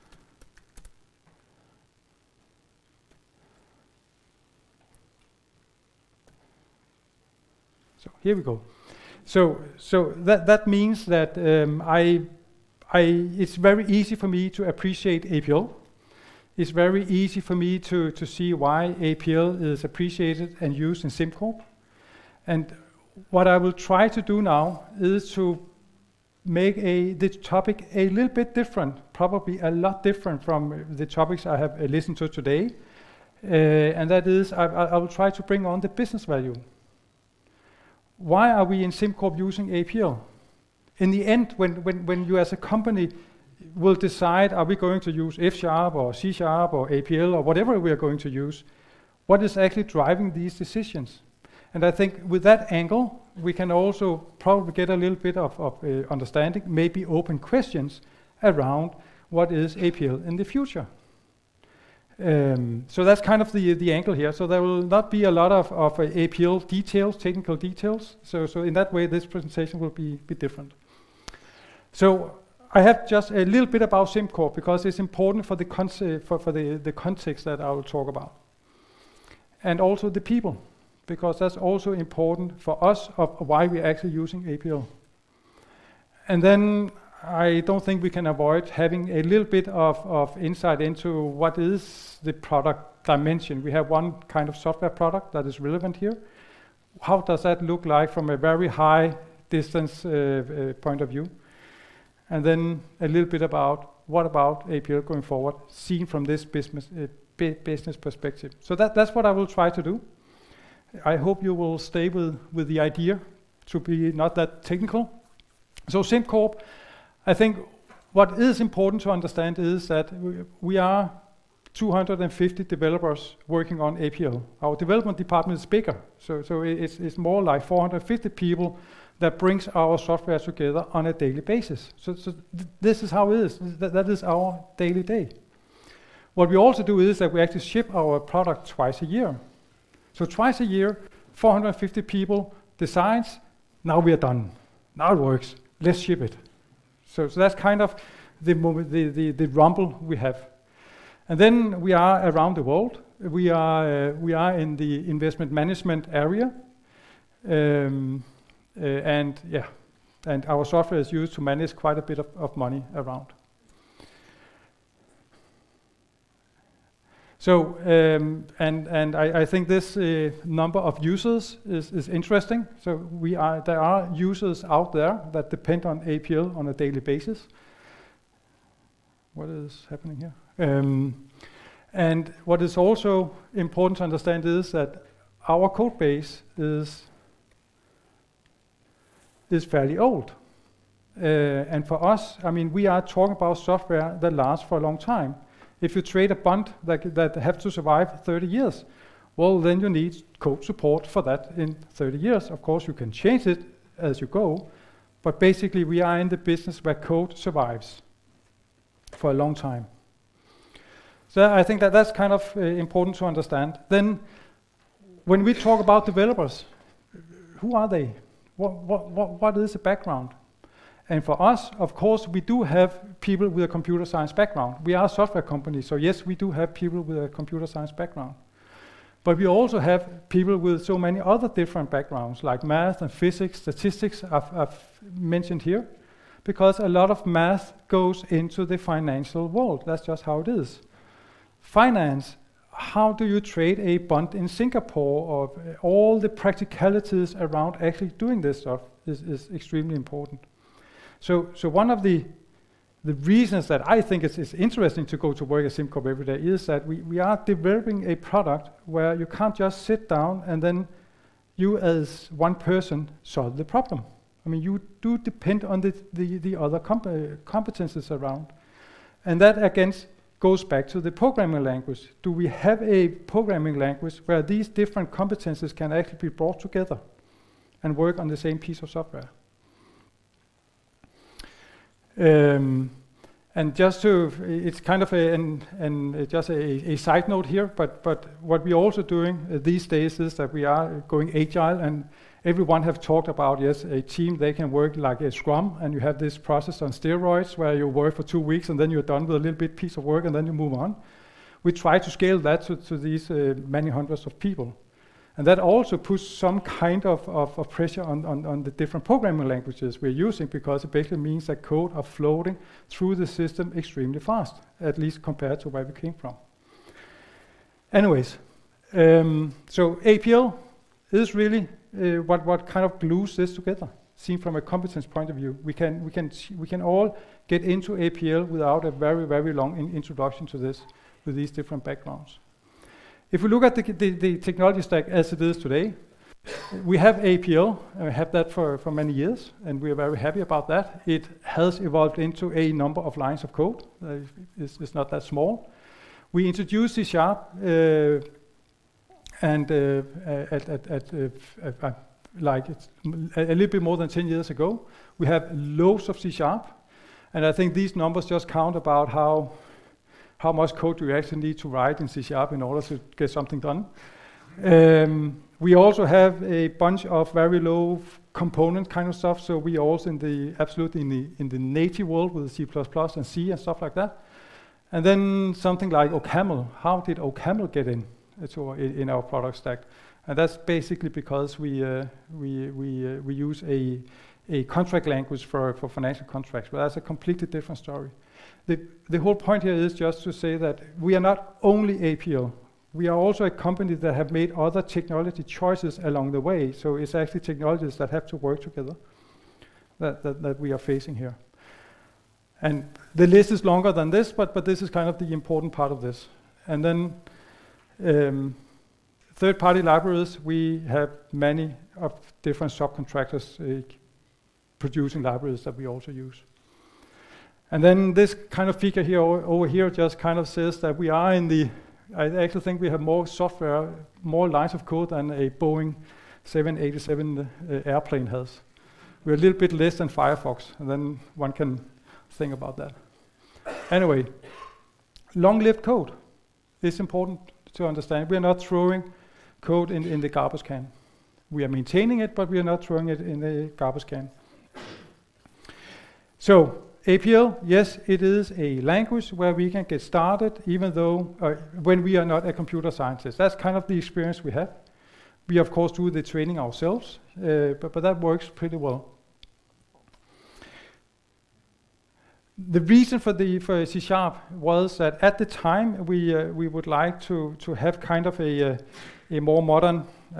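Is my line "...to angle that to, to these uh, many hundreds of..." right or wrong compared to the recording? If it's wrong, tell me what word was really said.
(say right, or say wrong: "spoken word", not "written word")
wrong: "scale", not "angle".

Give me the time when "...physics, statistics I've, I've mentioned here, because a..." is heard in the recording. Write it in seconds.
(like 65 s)
233 s.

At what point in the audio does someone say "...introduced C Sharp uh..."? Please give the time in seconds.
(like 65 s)
346 s.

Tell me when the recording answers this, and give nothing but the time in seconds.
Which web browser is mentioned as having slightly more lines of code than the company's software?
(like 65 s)
430 s.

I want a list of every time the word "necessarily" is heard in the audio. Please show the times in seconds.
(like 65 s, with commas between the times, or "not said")
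not said.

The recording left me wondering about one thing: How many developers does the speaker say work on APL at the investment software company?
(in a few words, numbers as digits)
250.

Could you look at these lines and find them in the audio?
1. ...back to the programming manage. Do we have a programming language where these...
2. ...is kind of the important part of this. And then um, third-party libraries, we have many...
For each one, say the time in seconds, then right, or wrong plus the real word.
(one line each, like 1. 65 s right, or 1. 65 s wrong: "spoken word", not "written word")
1. 270 s wrong: "language", not "manage"
2. 404 s right.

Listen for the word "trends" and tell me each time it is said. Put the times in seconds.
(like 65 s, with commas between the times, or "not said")
not said.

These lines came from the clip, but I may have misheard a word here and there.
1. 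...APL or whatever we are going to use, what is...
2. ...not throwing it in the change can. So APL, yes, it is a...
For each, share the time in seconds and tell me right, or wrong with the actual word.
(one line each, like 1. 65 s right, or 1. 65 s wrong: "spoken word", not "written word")
1. 46 s right
2. 442 s wrong: "garbage", not "change".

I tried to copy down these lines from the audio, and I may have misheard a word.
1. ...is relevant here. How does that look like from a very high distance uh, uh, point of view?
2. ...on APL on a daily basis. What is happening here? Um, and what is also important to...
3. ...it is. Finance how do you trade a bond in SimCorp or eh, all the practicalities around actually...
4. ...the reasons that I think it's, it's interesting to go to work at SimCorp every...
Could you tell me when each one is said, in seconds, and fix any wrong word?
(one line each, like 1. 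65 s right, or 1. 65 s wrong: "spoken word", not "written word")
1. 95 s right
2. 175 s right
3. 240 s wrong: "Singapore", not "SimCorp"
4. 253 s right.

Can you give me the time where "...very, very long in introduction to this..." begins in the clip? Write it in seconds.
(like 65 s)
328 s.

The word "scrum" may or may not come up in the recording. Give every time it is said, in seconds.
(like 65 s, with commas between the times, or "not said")
295 s.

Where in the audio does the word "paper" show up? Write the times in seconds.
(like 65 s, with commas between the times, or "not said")
not said.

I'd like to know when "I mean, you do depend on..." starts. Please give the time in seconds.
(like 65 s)
264 s.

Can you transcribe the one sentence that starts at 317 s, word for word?
Anyways, um, so APL is really uh, what, what kind of glues this together, seen from a competence point of view.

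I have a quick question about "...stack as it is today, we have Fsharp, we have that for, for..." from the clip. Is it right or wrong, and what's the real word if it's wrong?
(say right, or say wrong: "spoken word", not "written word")
wrong: "APL", not "Fsharp".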